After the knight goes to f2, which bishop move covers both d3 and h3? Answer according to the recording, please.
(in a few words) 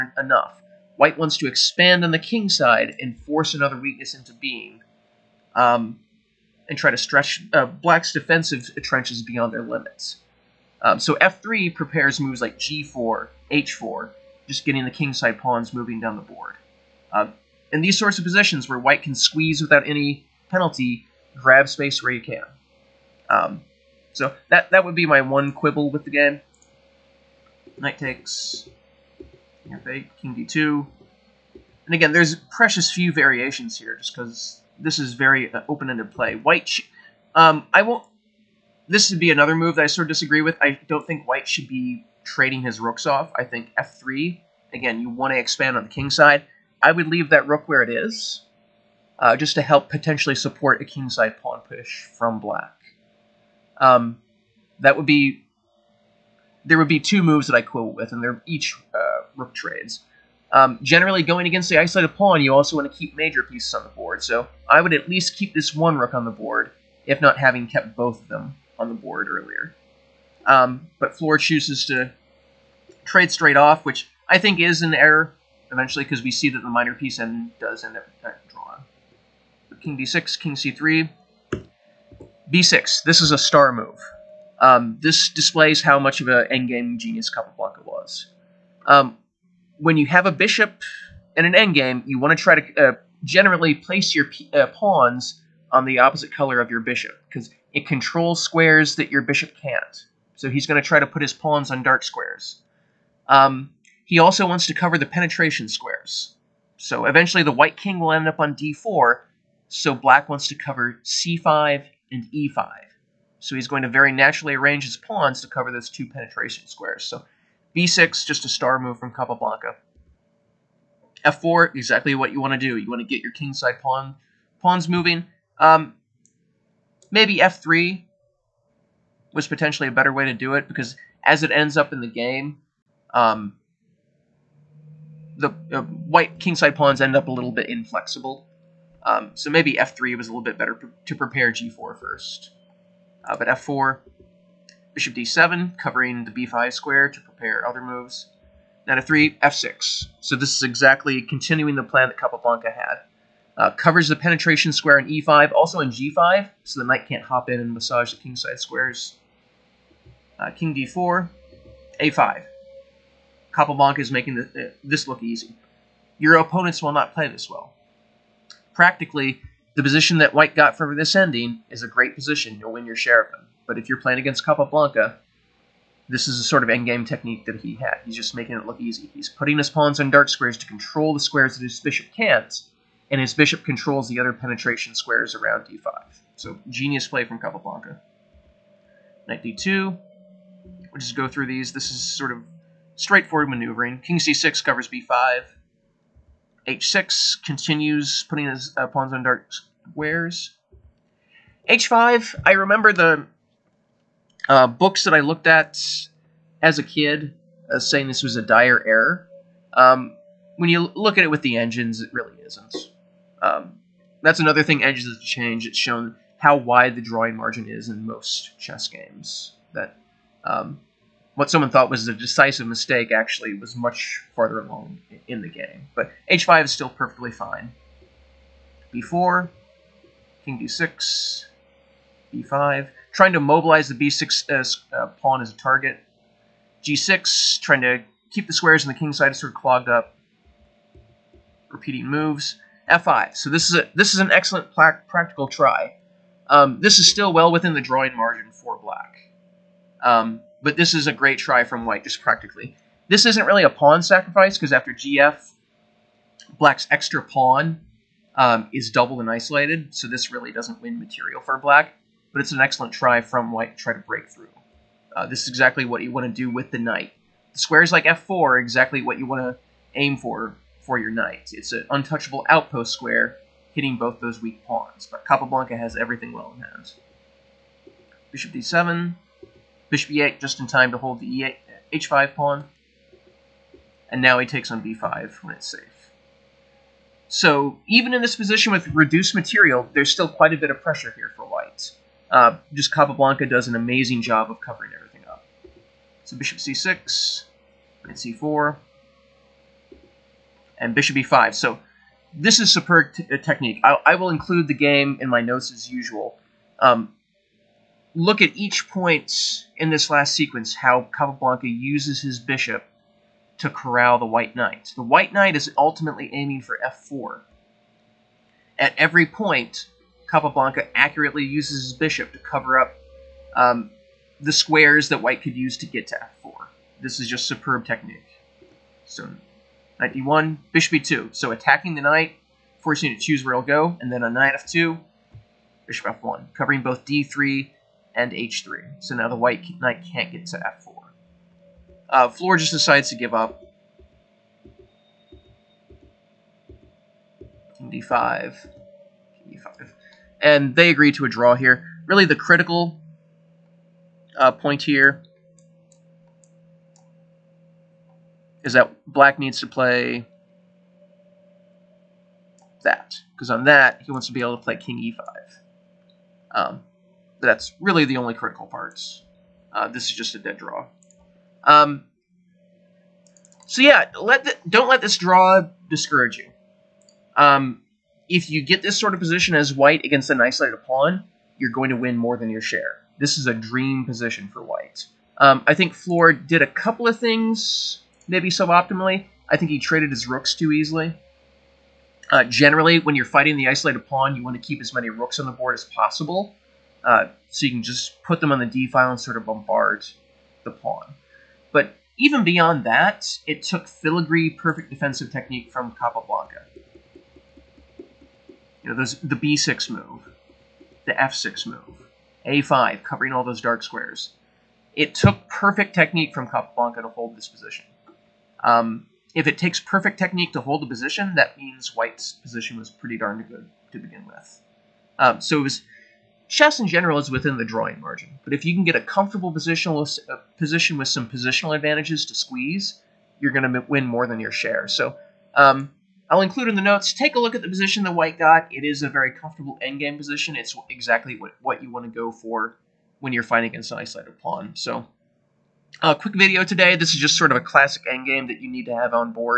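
Bishop f1.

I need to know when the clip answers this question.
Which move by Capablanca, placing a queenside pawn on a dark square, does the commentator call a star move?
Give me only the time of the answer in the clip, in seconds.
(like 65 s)
82 s.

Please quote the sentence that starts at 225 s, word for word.
But h5 is still perfectly fine.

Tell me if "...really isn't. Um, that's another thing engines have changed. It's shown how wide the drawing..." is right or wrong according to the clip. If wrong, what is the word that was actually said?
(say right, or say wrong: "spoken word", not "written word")
right.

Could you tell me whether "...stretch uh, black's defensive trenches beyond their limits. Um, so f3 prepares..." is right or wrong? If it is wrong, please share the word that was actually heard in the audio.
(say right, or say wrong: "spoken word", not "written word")
right.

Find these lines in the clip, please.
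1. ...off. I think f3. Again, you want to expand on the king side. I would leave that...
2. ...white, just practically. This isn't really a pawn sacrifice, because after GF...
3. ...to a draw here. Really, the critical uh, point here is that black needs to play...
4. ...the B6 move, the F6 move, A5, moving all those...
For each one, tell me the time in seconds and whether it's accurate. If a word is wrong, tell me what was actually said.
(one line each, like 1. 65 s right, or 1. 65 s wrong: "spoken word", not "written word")
1. 43 s right
2. 251 s right
3. 351 s right
4. 409 s wrong: "covering", not "moving".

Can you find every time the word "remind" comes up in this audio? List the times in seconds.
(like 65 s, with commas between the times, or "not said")
not said.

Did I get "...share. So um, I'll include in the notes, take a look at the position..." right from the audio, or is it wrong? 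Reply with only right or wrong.
right.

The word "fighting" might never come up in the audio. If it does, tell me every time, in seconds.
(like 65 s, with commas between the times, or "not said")
393 s, 443 s.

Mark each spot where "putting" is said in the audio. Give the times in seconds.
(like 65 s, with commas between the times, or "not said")
179 s, 198 s.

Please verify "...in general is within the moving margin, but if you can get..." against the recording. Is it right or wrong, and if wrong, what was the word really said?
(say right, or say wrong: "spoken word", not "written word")
wrong: "drawing", not "moving".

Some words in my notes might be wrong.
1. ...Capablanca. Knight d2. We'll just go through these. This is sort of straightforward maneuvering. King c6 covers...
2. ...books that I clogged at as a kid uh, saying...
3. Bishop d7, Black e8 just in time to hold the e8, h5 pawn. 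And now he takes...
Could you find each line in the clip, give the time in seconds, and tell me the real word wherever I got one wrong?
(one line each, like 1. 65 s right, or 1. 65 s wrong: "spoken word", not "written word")
1. 187 s right
2. 204 s wrong: "looked", not "clogged"
3. 278 s wrong: "Bishop", not "Black".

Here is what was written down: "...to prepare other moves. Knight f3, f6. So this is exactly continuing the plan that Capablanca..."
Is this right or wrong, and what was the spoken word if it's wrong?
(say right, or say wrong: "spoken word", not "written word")
right.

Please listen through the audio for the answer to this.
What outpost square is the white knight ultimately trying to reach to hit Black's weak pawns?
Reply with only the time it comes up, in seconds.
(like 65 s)
314 s.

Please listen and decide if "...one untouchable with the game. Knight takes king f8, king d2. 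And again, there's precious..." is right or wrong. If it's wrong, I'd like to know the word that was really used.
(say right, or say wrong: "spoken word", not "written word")
wrong: "quibble", not "untouchable".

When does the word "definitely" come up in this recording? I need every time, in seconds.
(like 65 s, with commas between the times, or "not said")
not said.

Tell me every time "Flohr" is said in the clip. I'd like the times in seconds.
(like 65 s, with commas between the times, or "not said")
71 s, 342 s, 385 s.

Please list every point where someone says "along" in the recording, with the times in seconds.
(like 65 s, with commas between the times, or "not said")
224 s.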